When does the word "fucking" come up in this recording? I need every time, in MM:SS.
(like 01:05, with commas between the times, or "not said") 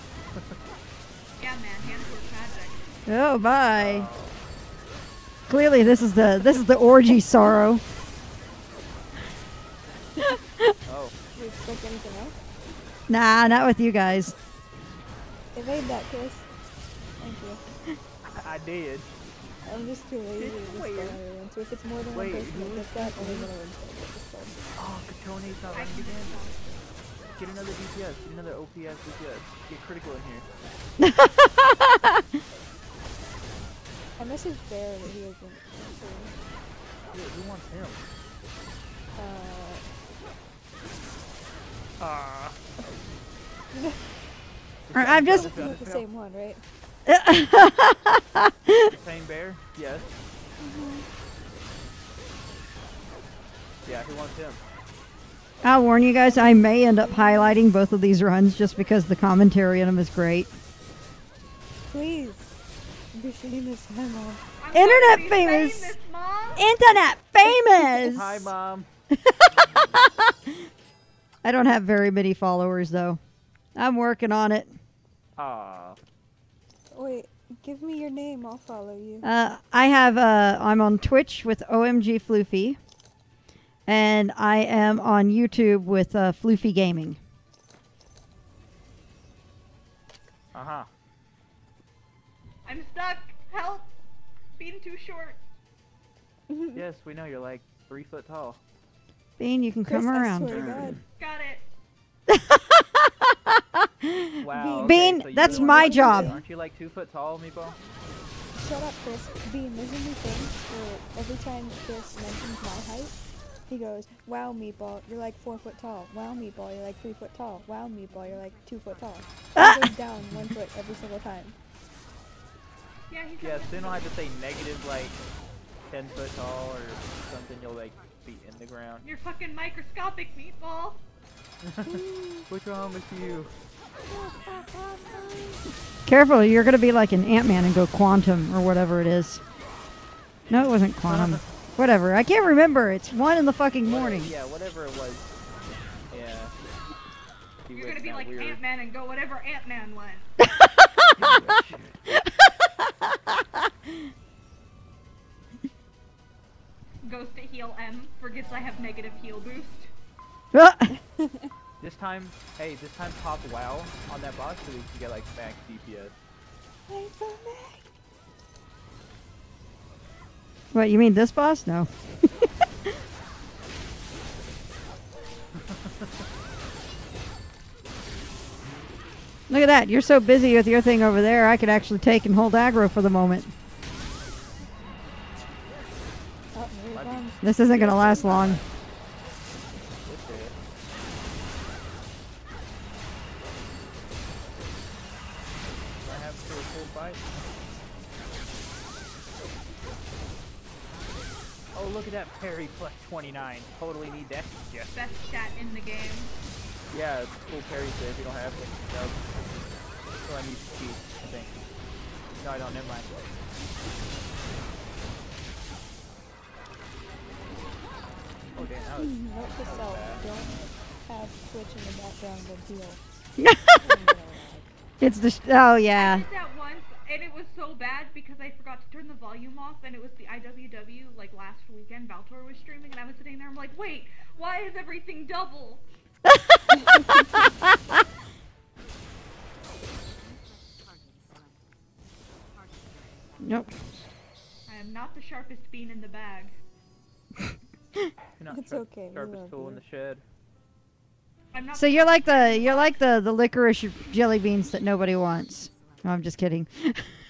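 02:09, 02:23.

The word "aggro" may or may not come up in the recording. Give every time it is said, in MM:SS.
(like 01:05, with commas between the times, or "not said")
03:02.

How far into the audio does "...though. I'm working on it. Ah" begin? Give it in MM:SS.
01:12.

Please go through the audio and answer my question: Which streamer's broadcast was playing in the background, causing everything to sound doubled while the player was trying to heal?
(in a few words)
Valtor.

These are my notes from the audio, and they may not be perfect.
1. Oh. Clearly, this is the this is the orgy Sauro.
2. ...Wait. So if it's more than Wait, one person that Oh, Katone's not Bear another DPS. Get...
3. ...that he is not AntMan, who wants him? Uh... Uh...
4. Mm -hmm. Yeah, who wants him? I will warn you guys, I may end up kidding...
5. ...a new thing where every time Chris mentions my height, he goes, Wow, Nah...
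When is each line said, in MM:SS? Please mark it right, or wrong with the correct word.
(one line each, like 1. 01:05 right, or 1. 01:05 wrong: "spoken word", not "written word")
1. 00:03 right
2. 00:20 wrong: "Get", not "Bear"
3. 00:34 wrong: "Dude", not "AntMan"
4. 00:49 wrong: "highlighting", not "kidding"
5. 01:49 wrong: "Meatball", not "Nah".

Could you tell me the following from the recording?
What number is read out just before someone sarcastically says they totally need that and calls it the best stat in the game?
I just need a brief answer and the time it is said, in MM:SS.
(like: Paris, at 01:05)
29, at 03:23.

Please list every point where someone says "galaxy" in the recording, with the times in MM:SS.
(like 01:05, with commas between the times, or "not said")
not said.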